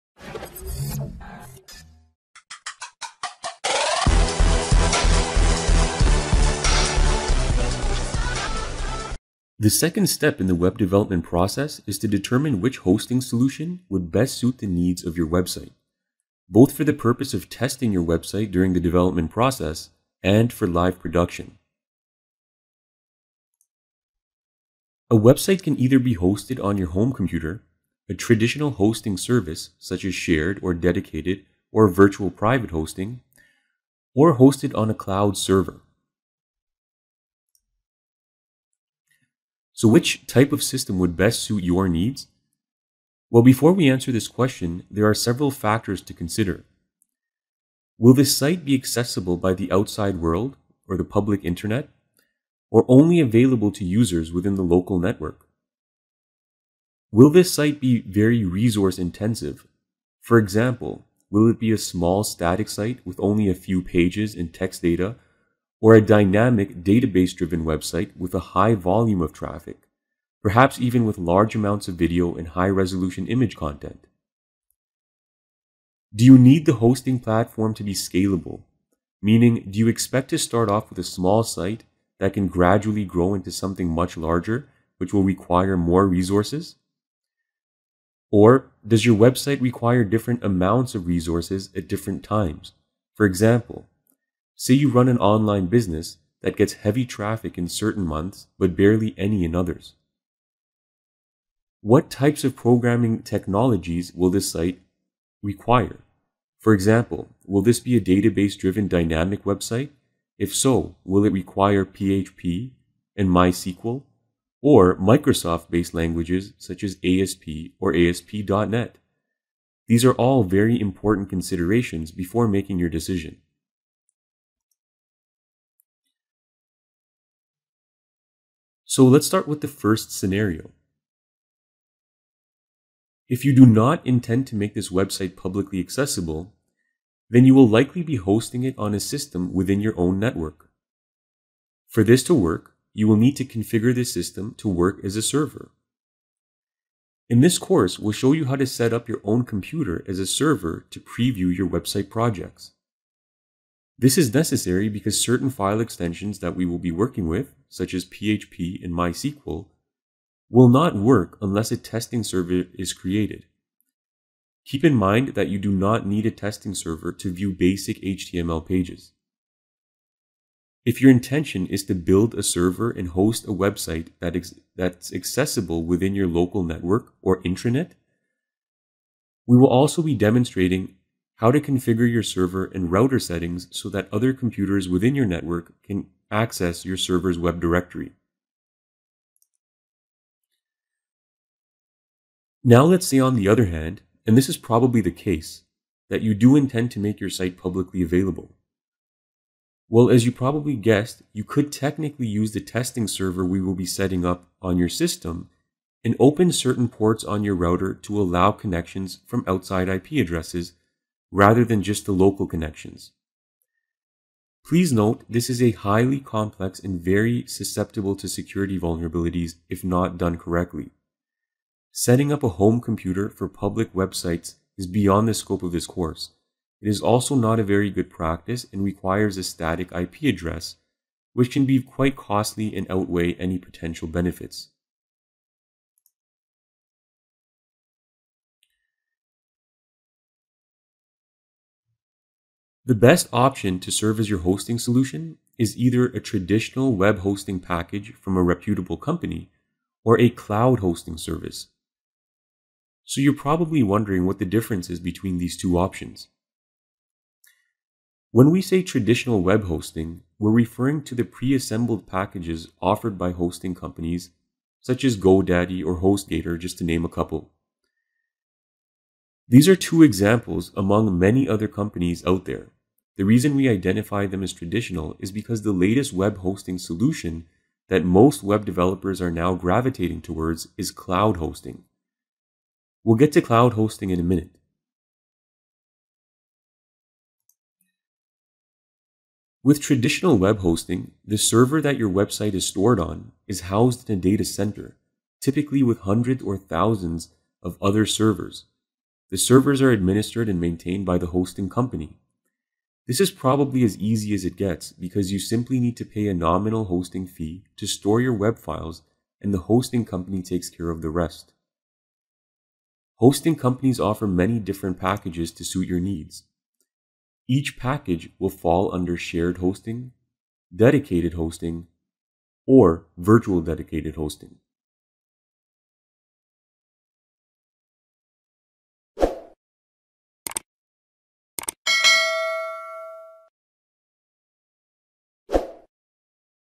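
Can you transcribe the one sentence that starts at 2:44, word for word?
Keep in mind that you do not need a testing server to view basic HTML pages.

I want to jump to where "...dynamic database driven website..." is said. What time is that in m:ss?
1:06.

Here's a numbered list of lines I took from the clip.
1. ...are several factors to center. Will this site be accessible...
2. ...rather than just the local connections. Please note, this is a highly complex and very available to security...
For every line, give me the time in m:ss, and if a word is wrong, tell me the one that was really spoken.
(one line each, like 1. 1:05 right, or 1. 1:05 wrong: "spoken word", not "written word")
1. 0:45 wrong: "consider", not "center"
2. 3:31 wrong: "susceptible", not "available".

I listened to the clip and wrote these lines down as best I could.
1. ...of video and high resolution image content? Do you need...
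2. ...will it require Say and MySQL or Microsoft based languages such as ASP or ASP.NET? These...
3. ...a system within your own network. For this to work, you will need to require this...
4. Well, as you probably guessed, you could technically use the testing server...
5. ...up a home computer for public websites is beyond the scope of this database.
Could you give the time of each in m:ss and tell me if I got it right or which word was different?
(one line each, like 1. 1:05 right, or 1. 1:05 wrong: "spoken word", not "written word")
1. 1:11 right
2. 1:51 wrong: "PHP", not "Say"
3. 2:18 wrong: "configure", not "require"
4. 3:19 right
5. 3:42 wrong: "course", not "database".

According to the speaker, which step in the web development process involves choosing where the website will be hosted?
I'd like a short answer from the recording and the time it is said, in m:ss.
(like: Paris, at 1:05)
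Second, at 0:09.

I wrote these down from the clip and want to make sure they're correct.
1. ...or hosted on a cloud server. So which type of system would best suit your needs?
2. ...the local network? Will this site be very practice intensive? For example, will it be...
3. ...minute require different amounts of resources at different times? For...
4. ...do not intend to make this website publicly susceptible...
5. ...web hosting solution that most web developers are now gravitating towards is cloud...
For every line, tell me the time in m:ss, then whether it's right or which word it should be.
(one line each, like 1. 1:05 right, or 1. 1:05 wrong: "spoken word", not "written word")
1. 0:34 right
2. 0:54 wrong: "resource", not "practice"
3. 1:29 wrong: "website", not "minute"
4. 2:13 wrong: "accessible", not "susceptible"
5. 4:36 right.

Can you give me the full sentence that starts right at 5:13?
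Hosting companies offer many different packages to suit your needs.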